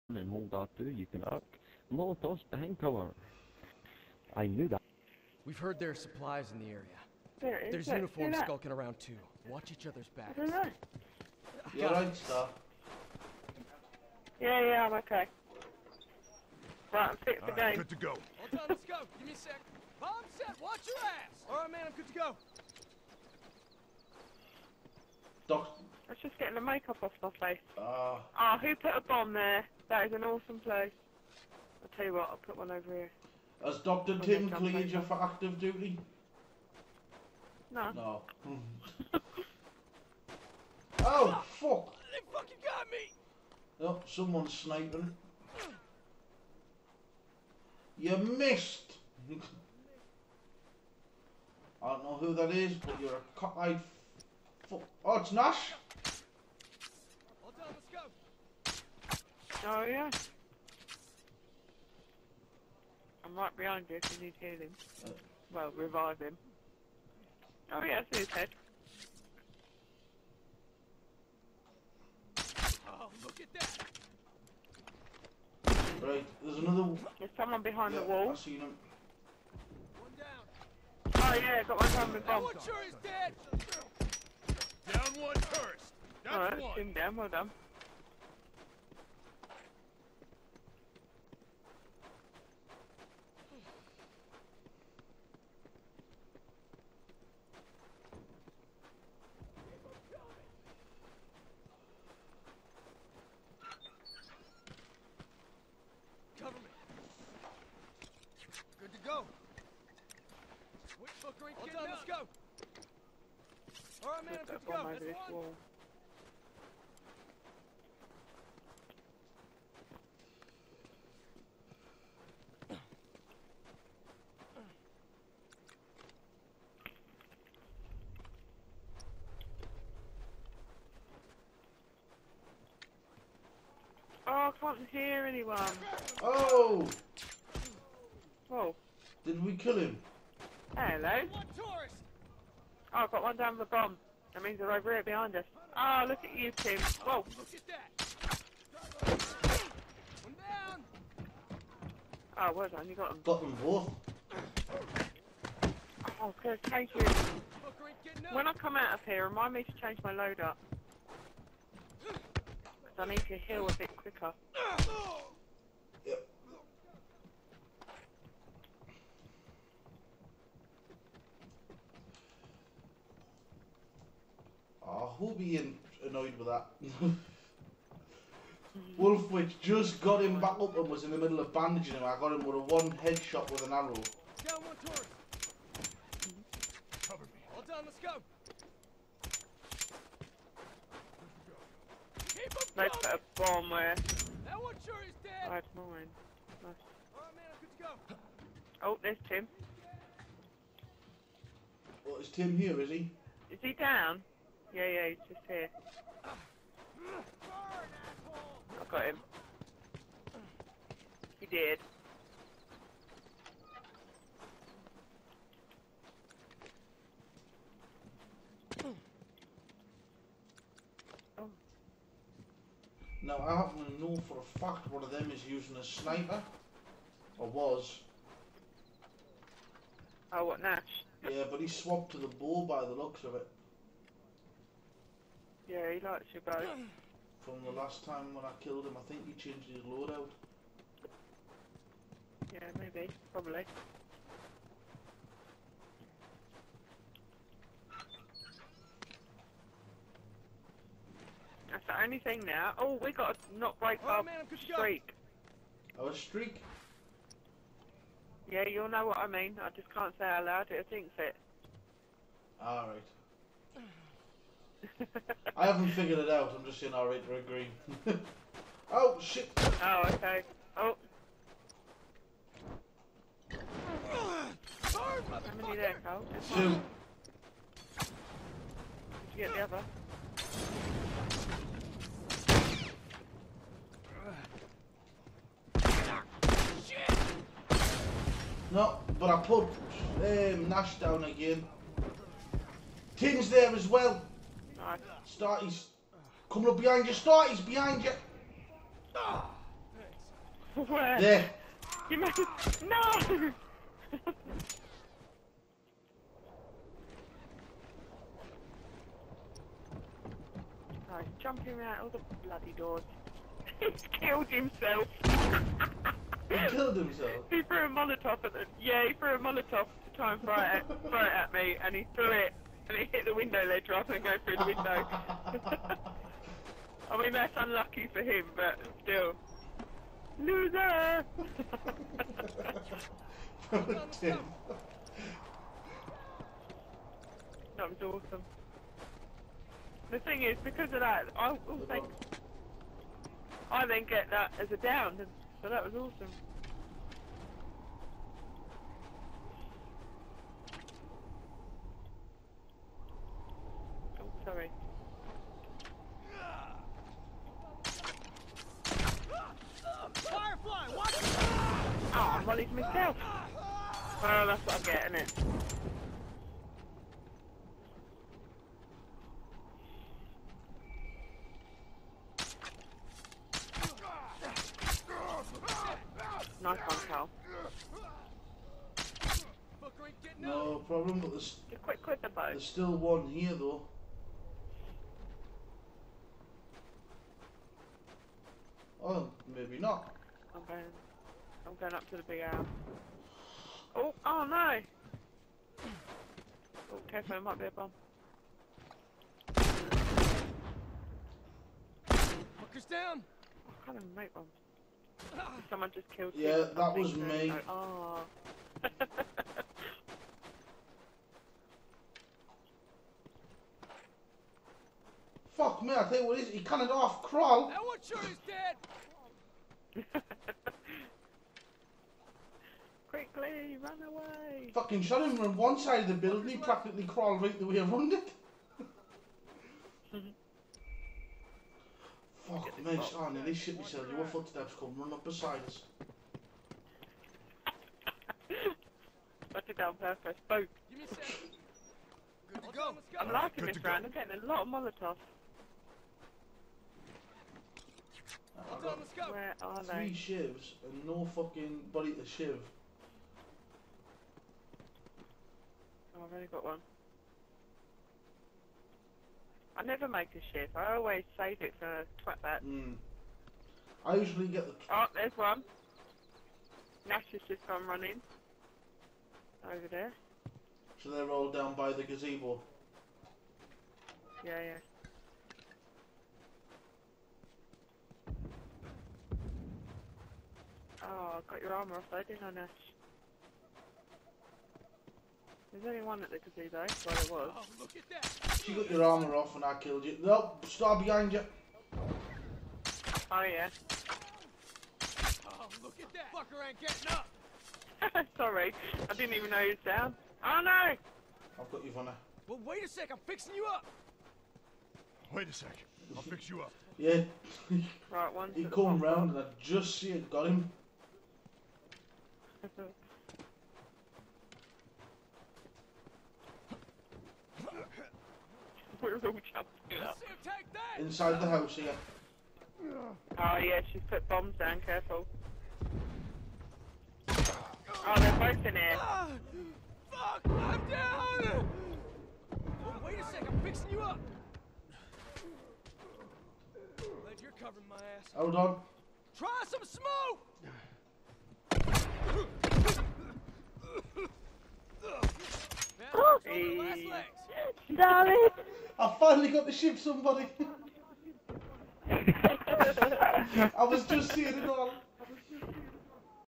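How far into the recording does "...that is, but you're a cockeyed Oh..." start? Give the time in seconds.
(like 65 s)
52 s.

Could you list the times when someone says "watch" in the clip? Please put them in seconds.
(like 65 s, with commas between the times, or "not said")
9 s, 20 s.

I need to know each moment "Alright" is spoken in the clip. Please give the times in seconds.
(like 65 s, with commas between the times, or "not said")
21 s, 114 s, 197 s, 262 s.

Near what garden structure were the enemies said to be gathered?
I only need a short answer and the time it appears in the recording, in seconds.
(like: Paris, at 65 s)
Gazebo, at 472 s.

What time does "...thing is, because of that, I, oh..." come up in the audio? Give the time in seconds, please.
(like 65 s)
340 s.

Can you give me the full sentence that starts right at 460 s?
I always save it for twat that.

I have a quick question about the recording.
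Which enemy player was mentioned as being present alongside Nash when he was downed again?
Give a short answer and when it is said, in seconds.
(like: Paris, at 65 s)
King, at 293 s.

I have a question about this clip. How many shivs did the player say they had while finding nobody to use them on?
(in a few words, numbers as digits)
3.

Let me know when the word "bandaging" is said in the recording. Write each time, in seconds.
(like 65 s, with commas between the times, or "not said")
181 s.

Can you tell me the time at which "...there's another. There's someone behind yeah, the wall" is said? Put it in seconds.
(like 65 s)
76 s.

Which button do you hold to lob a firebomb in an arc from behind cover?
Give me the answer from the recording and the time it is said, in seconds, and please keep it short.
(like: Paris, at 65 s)
R2, at 0 s.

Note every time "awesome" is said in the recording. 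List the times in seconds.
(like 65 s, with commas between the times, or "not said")
30 s, 338 s, 345 s.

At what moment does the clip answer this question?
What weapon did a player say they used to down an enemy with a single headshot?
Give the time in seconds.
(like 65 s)
183 s.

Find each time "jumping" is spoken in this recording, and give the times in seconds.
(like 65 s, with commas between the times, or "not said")
311 s, 519 s.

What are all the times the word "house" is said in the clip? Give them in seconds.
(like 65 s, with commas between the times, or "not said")
521 s.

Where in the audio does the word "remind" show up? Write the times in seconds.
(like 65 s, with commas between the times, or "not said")
159 s.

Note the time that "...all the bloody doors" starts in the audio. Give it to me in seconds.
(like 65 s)
312 s.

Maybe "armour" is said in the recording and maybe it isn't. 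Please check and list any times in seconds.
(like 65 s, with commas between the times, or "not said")
481 s, 489 s.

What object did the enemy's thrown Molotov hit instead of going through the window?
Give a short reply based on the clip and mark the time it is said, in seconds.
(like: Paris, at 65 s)
Window ledge, at 323 s.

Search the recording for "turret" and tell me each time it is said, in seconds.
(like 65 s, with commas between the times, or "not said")
184 s.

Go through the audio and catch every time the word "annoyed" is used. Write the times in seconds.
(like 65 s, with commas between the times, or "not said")
176 s.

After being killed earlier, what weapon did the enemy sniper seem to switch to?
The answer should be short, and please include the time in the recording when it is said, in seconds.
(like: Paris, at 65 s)
Bow, at 232 s.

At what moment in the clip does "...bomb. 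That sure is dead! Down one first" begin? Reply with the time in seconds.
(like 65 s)
82 s.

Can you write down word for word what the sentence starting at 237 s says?
From the last time when I killed him, I think he changed his loadout.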